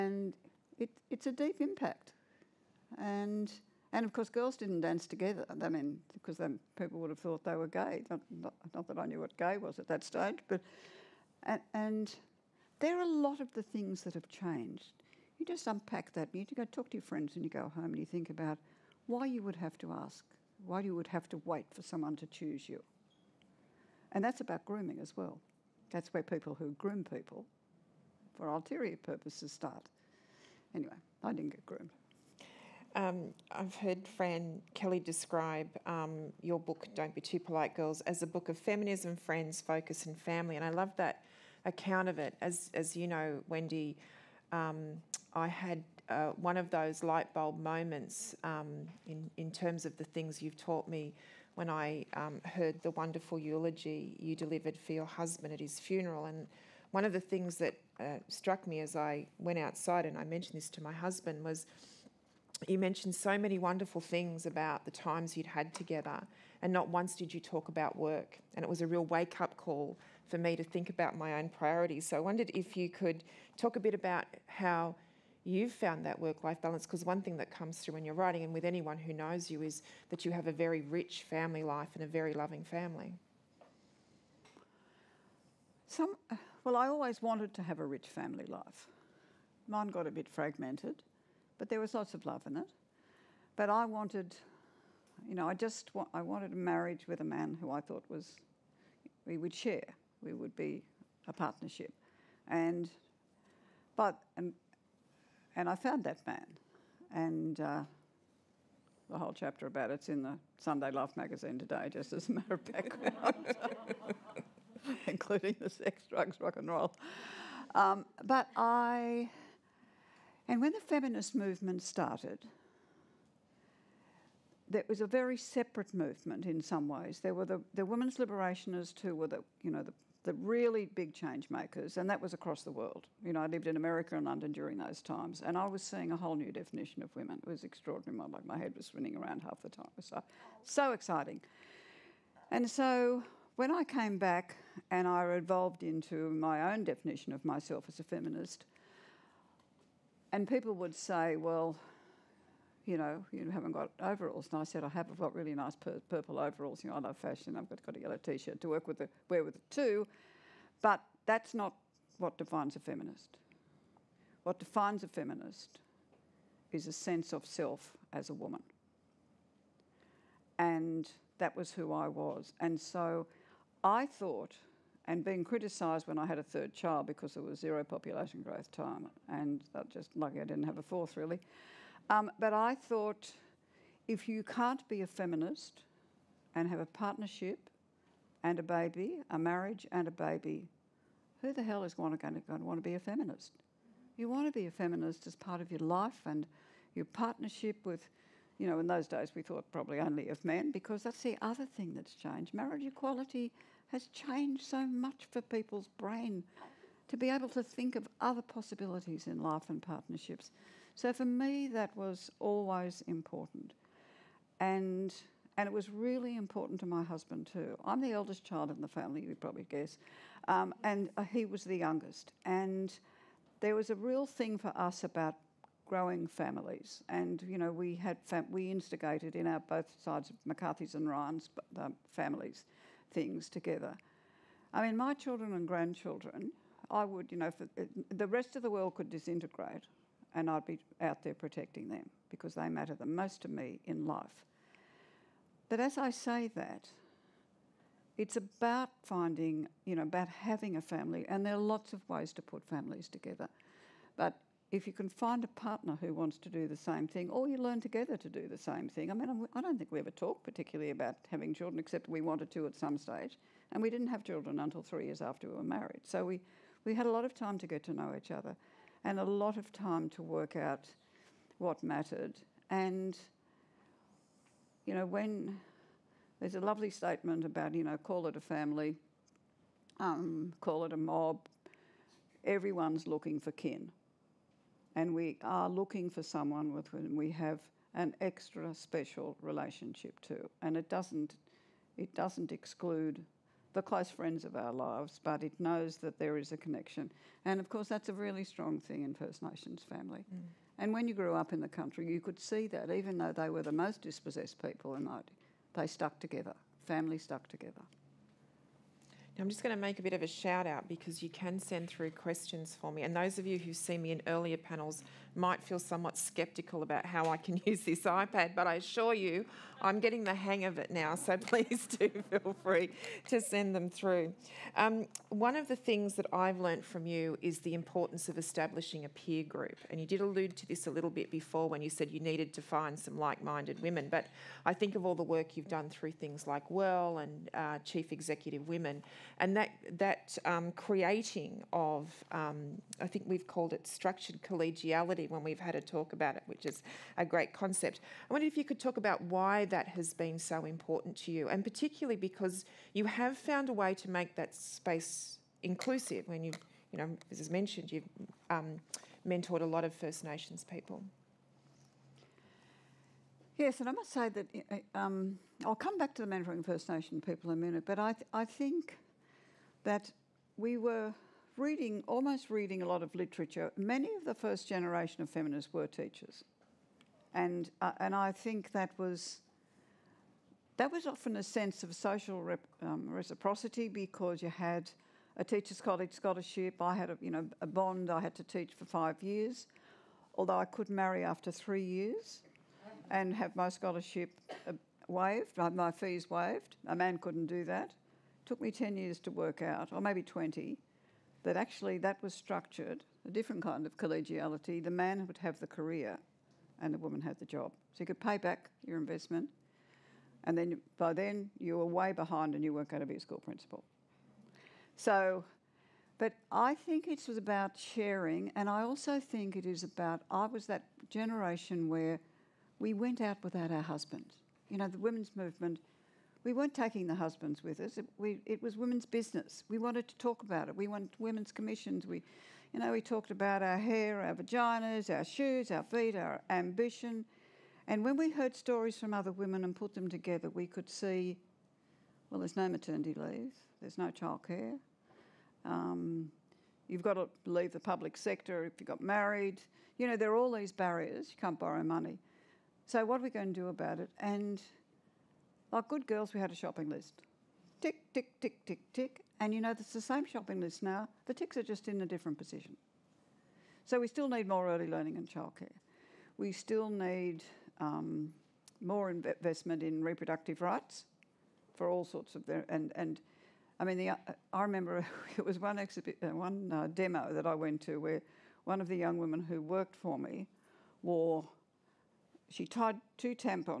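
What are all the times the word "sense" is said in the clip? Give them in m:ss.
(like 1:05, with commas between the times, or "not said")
2:46, 6:21.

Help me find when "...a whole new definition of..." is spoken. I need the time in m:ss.
2:16.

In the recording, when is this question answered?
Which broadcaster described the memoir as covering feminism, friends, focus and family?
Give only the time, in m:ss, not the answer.
0:34.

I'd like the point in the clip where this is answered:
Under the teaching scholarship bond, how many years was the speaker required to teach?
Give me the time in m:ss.
6:28.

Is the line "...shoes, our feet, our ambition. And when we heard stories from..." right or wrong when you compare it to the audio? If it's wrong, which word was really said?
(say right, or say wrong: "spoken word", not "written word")
right.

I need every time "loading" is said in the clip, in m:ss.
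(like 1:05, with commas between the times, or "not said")
not said.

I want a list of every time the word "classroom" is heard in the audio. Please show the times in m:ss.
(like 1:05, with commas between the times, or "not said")
not said.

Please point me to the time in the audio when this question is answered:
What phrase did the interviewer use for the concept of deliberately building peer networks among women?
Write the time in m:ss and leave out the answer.
5:43.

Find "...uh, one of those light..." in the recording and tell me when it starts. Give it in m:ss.
0:46.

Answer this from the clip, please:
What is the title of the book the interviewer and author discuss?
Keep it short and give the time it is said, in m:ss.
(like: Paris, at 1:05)
Don't Be Too Polite Girls, at 0:36.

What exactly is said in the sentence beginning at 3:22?
Marriage equality has changed so much for people's brain to be able to think of other possibilities in life and partnerships.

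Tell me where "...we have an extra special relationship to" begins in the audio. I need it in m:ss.
4:47.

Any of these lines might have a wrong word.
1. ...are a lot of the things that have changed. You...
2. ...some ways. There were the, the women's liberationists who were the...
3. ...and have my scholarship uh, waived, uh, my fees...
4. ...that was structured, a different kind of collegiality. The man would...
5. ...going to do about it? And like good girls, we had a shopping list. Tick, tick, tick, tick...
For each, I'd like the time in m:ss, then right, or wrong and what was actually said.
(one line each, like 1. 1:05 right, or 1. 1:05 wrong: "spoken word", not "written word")
1. 0:12 right
2. 2:06 right
3. 6:33 right
4. 6:41 right
5. 7:33 right.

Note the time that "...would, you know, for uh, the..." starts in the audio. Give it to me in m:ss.
3:57.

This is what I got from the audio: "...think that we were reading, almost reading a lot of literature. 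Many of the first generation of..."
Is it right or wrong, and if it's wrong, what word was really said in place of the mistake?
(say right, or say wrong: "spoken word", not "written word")
right.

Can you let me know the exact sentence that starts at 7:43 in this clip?
So we still need more early learning and childcare.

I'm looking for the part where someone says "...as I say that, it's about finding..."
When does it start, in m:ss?
4:05.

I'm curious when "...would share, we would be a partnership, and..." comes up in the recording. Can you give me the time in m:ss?
1:39.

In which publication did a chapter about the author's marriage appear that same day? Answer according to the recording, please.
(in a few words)
Sunday Life magazine.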